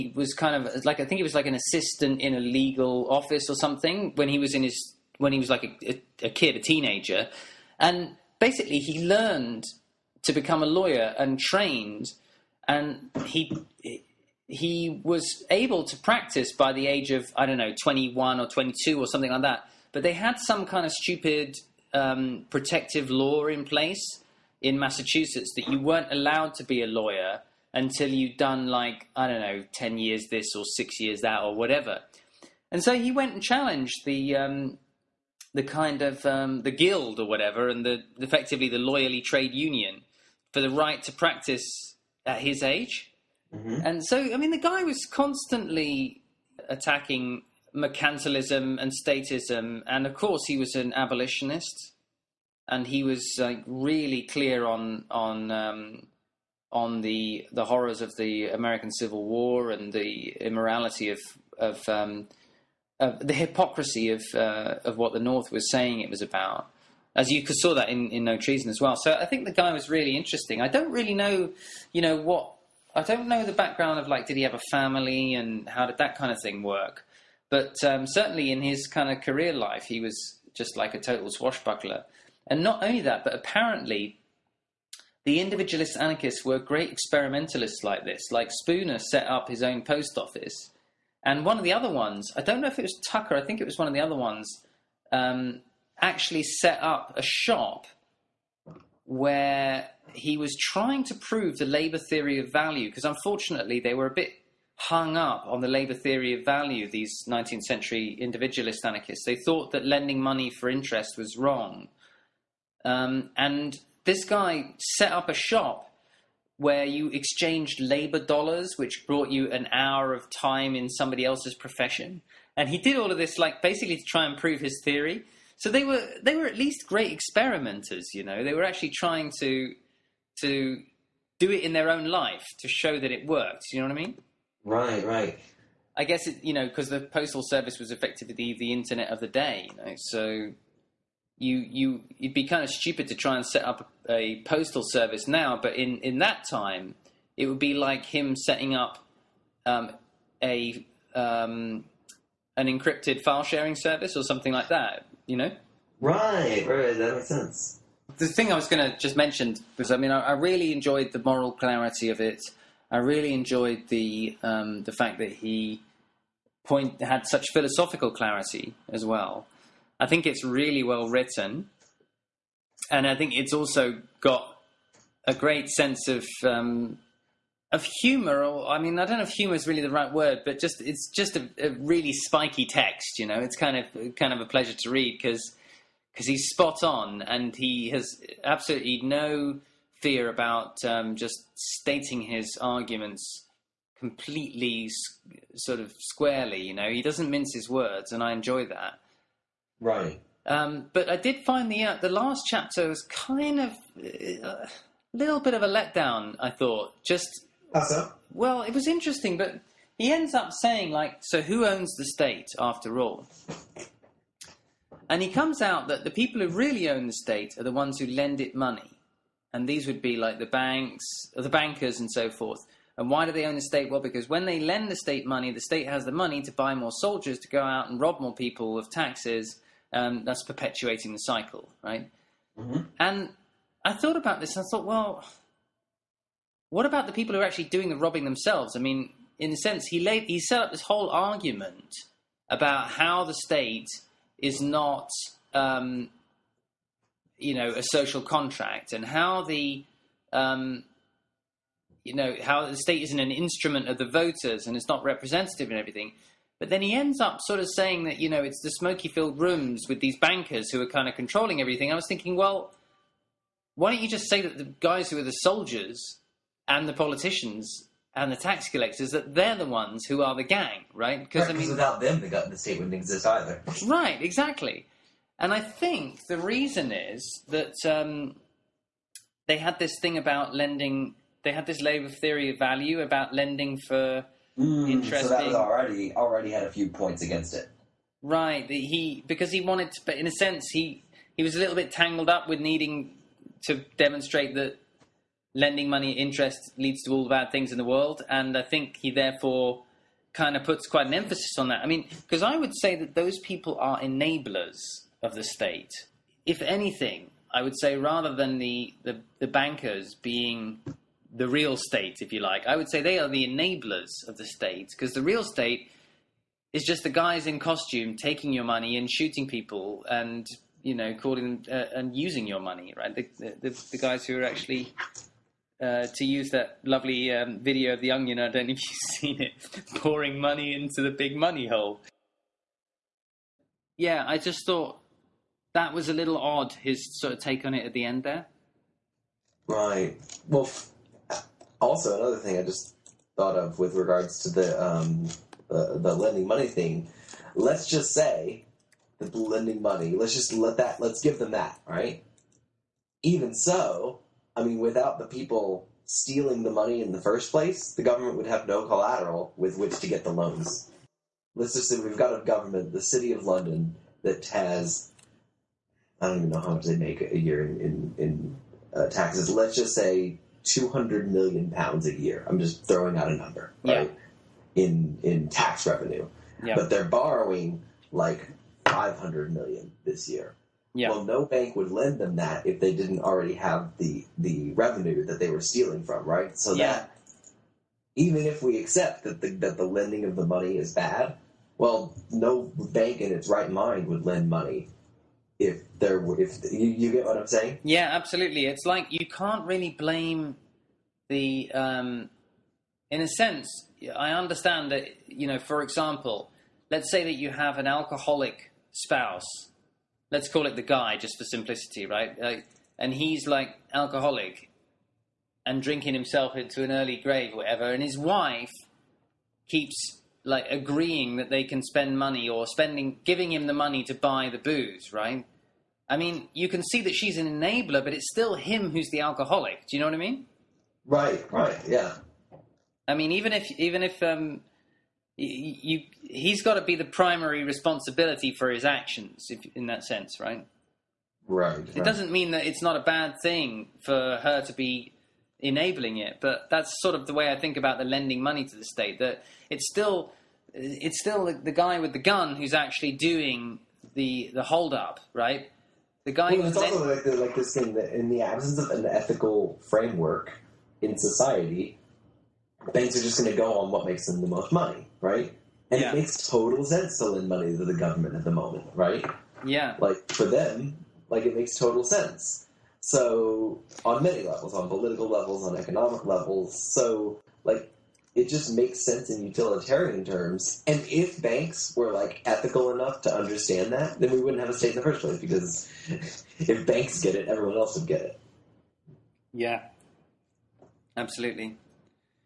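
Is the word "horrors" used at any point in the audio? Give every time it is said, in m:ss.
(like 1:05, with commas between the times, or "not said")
0:57.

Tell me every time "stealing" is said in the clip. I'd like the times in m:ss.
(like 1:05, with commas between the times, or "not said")
5:56, 6:25.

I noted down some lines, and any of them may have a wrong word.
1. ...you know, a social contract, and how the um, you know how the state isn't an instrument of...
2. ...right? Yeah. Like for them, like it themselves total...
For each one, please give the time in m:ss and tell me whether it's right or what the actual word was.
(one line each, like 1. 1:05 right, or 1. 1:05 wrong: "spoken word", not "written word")
1. 4:07 right
2. 7:48 wrong: "makes", not "themselves".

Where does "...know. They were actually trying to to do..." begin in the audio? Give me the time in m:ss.
2:08.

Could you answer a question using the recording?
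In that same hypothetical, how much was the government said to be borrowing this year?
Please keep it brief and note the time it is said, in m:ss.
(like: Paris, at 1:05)
500 million, at 6:18.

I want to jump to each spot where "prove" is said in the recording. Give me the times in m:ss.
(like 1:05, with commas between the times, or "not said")
1:41, 2:04.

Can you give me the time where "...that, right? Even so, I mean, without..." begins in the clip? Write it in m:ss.
5:51.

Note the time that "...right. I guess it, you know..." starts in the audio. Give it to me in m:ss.
2:15.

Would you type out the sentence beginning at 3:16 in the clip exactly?
You know, he doesn't mince his words, and I enjoy that.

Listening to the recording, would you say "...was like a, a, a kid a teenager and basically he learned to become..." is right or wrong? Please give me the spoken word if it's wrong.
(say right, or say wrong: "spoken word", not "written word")
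right.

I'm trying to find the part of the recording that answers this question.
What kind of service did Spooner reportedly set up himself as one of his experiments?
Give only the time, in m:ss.
1:29.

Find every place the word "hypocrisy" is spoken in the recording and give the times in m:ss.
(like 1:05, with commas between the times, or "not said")
1:03.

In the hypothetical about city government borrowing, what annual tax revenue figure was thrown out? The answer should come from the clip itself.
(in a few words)
200 million pounds.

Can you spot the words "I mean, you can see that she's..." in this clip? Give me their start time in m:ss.
7:06.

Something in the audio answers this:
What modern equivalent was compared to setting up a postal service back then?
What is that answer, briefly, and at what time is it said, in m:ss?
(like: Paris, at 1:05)
Encrypted file sharing service, at 2:32.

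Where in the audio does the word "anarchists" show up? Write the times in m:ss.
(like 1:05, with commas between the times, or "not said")
1:25, 1:48.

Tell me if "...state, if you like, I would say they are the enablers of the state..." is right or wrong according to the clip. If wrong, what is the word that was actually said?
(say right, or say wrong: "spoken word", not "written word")
right.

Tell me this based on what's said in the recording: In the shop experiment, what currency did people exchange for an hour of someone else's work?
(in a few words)
Labor dollars.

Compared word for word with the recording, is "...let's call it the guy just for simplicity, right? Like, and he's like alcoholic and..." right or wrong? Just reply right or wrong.
right.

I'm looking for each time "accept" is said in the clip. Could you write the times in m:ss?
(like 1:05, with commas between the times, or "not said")
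6:28.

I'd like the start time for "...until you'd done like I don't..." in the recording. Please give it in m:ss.
0:27.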